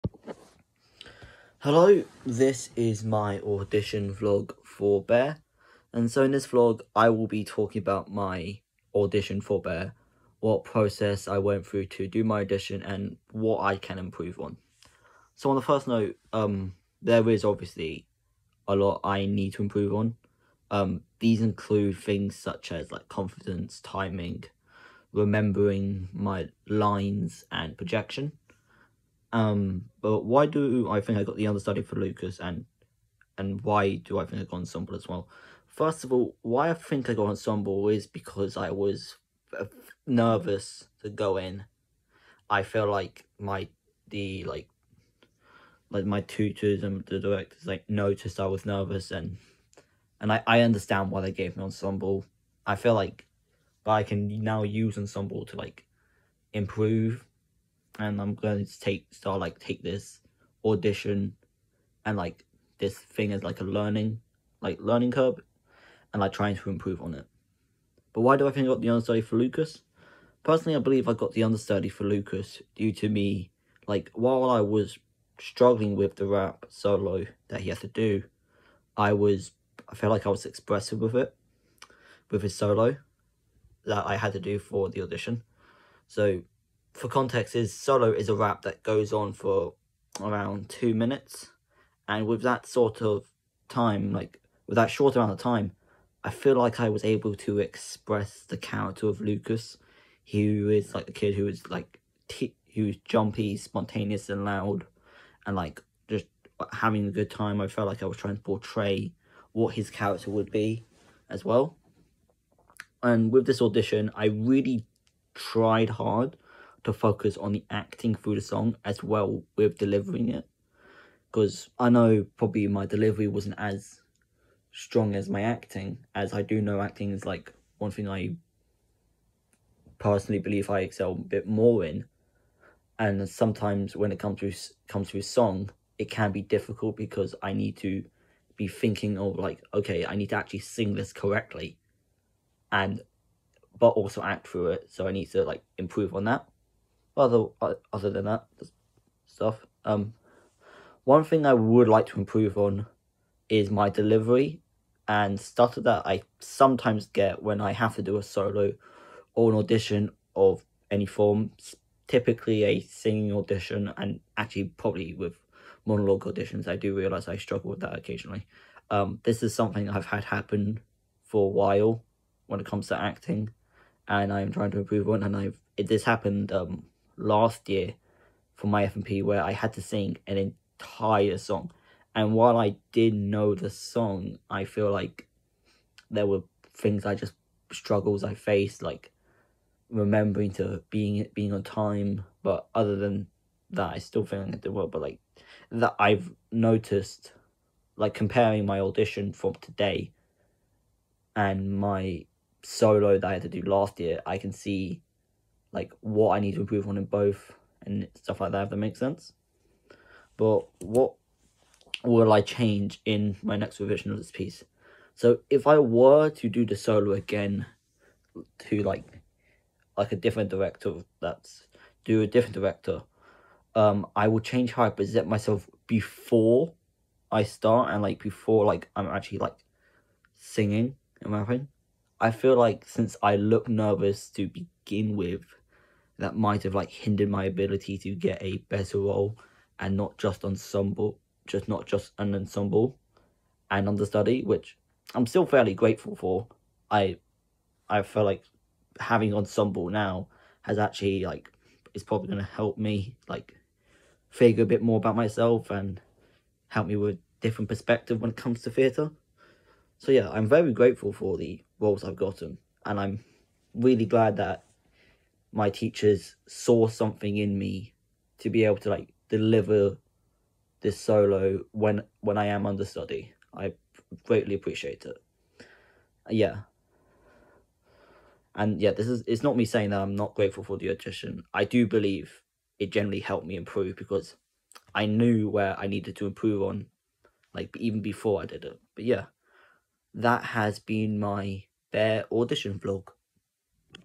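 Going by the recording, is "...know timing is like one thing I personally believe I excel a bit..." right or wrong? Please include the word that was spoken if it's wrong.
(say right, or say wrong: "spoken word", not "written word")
wrong: "acting", not "timing".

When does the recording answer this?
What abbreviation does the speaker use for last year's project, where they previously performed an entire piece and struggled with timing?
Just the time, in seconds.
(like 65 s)
178 s.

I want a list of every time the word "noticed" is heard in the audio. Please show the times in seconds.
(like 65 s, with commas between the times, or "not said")
47 s, 196 s.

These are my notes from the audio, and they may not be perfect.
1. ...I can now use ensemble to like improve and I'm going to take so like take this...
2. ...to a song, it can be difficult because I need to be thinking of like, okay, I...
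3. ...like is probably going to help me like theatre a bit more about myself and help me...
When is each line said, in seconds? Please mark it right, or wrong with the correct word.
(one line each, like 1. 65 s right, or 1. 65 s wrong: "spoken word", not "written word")
1. 53 s right
2. 135 s right
3. 251 s wrong: "figure", not "theatre".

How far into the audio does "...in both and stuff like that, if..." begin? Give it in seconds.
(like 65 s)
206 s.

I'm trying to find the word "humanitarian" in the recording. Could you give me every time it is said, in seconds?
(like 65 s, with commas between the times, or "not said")
not said.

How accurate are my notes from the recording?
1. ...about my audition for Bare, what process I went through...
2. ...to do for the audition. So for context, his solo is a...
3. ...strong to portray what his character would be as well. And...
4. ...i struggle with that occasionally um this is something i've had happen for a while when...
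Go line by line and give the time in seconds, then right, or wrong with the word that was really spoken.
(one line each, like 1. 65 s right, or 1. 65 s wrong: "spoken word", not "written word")
1. 7 s right
2. 84 s right
3. 108 s wrong: "trying", not "strong"
4. 167 s right.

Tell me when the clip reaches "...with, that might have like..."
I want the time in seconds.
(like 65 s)
235 s.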